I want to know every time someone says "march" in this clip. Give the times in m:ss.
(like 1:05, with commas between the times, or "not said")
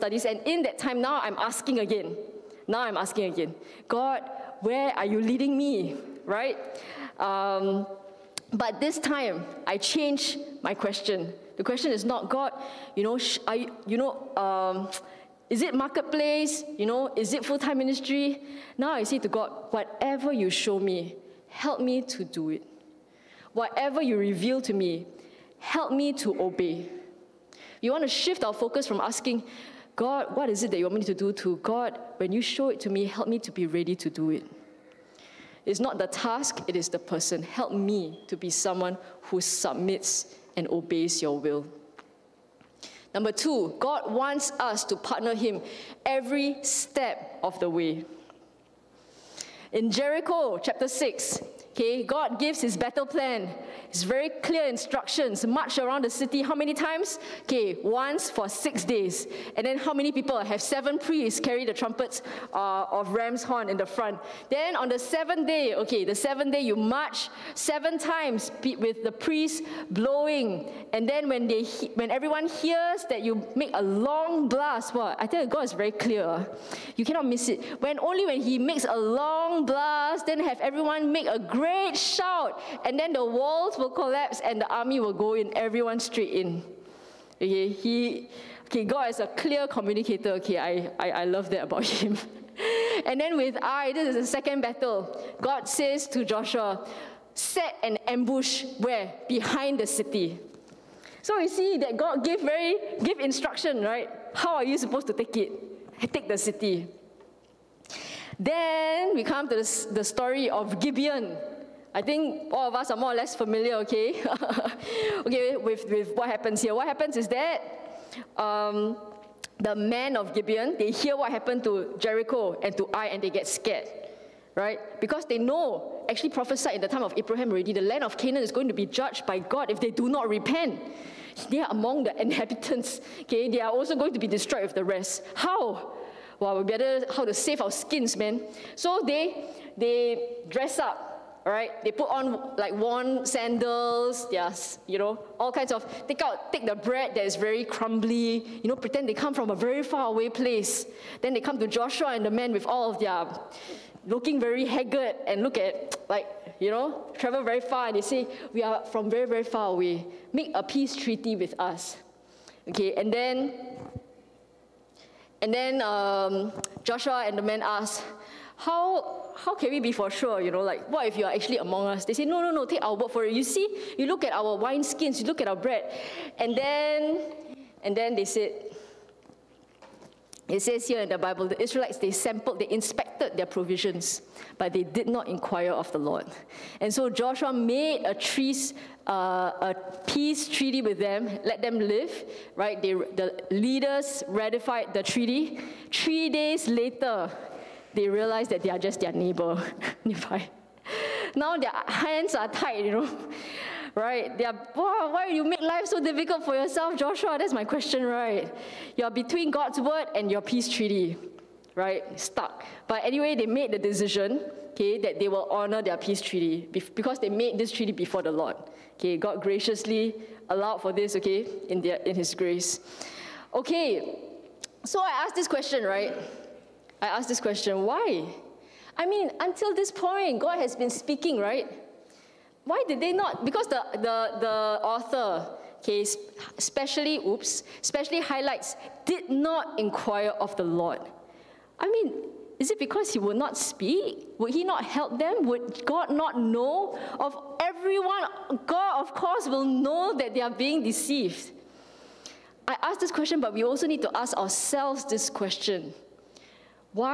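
0:55, 1:06.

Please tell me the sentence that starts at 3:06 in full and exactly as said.
And so Joshua made a, trees, uh, a peace treaty with them, let them live, right?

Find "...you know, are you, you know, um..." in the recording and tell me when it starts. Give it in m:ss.
0:12.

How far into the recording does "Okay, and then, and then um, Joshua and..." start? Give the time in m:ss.
2:42.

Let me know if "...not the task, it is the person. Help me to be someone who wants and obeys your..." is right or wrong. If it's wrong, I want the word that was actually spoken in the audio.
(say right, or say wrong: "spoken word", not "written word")
wrong: "submits", not "wants".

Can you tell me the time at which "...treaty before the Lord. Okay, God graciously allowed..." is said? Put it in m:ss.
3:37.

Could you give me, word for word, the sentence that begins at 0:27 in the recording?
You want to shift our focus from asking, God, what is it that you want me to do to God?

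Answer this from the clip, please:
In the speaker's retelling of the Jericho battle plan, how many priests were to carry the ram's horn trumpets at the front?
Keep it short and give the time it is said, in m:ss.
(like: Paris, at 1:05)
7, at 1:00.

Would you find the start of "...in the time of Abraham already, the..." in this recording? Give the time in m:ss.
2:06.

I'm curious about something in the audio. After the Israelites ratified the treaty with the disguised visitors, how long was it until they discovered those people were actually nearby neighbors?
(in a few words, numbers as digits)
3 days.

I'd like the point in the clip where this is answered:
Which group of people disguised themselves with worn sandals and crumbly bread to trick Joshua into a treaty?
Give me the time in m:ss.
1:59.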